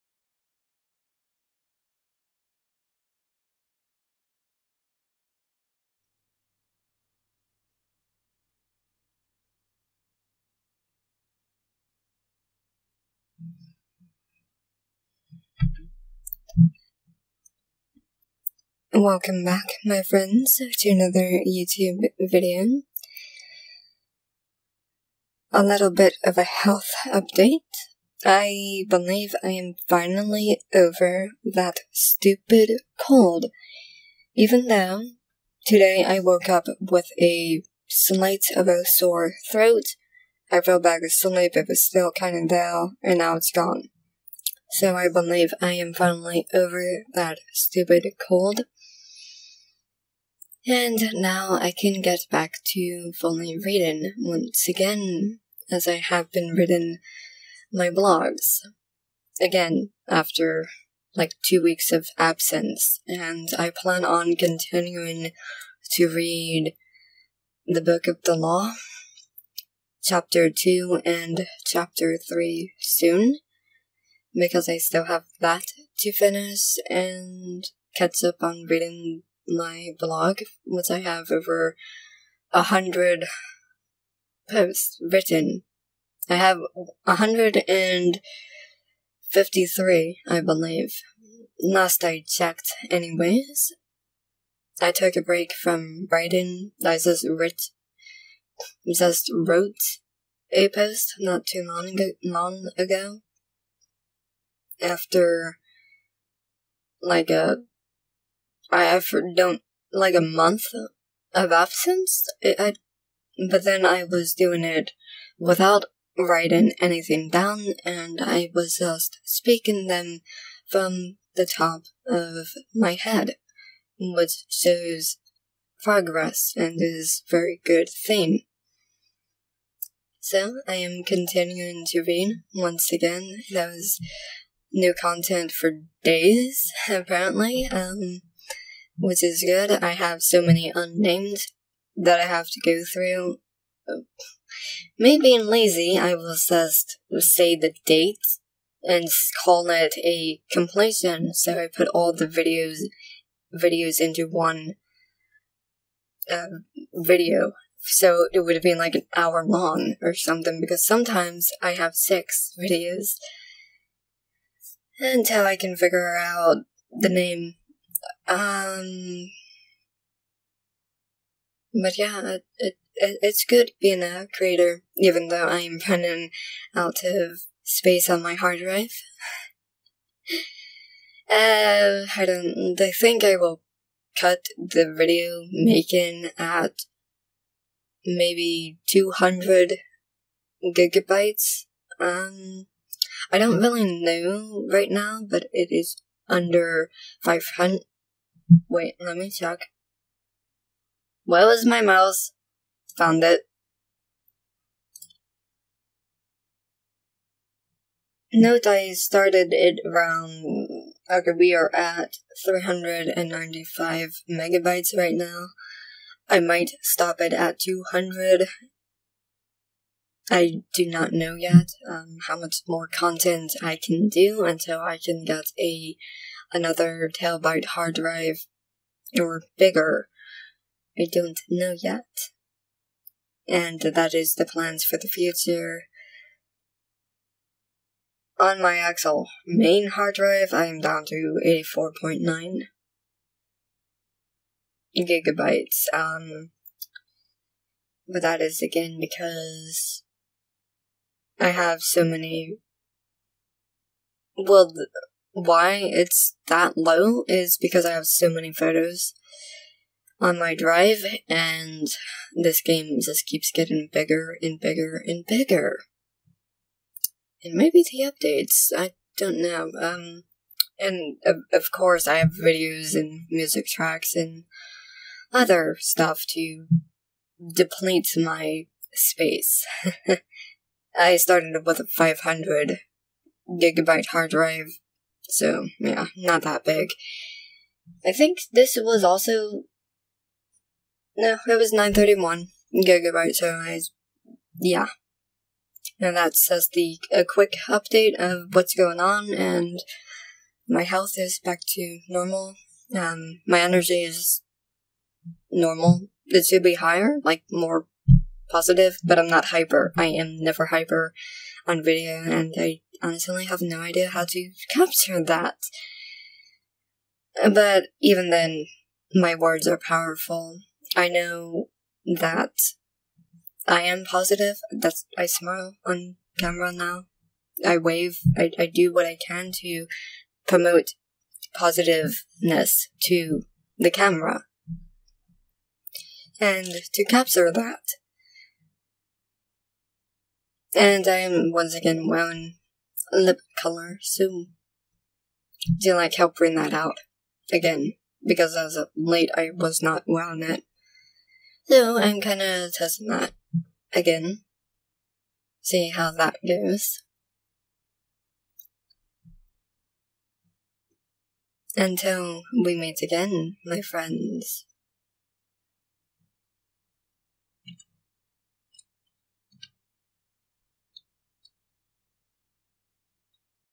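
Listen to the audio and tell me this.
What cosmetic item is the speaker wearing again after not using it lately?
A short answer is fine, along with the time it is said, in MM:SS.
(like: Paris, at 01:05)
lip color, at 05:43.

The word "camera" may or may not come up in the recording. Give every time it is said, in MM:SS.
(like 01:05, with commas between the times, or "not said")
05:26, 05:33.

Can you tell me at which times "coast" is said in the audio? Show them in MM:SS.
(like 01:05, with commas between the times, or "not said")
not said.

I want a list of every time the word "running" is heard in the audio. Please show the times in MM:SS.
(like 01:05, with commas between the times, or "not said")
02:55.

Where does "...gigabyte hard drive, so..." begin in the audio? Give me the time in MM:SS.
04:43.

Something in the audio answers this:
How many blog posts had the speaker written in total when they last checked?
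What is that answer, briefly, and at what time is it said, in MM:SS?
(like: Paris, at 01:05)
153, at 01:27.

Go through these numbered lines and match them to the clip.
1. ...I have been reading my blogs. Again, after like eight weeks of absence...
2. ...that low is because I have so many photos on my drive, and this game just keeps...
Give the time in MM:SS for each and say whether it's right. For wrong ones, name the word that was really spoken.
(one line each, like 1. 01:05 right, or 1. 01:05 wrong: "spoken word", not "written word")
1. 00:55 wrong: "two", not "eight"
2. 04:16 right.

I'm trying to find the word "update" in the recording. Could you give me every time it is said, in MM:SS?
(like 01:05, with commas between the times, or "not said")
00:27, 04:28, 04:57.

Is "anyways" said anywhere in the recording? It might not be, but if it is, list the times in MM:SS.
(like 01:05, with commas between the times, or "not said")
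01:32.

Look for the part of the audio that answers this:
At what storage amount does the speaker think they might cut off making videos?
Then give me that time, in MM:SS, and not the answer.
03:08.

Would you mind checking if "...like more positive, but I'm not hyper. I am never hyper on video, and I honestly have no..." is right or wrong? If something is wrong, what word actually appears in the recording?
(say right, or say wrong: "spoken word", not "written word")
right.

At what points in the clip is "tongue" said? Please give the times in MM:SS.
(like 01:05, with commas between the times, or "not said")
not said.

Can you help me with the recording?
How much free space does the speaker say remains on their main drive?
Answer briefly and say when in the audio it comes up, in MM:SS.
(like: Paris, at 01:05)
84.9 gigabytes, at 04:01.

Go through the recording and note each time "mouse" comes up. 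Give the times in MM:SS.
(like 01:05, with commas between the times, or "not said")
03:21.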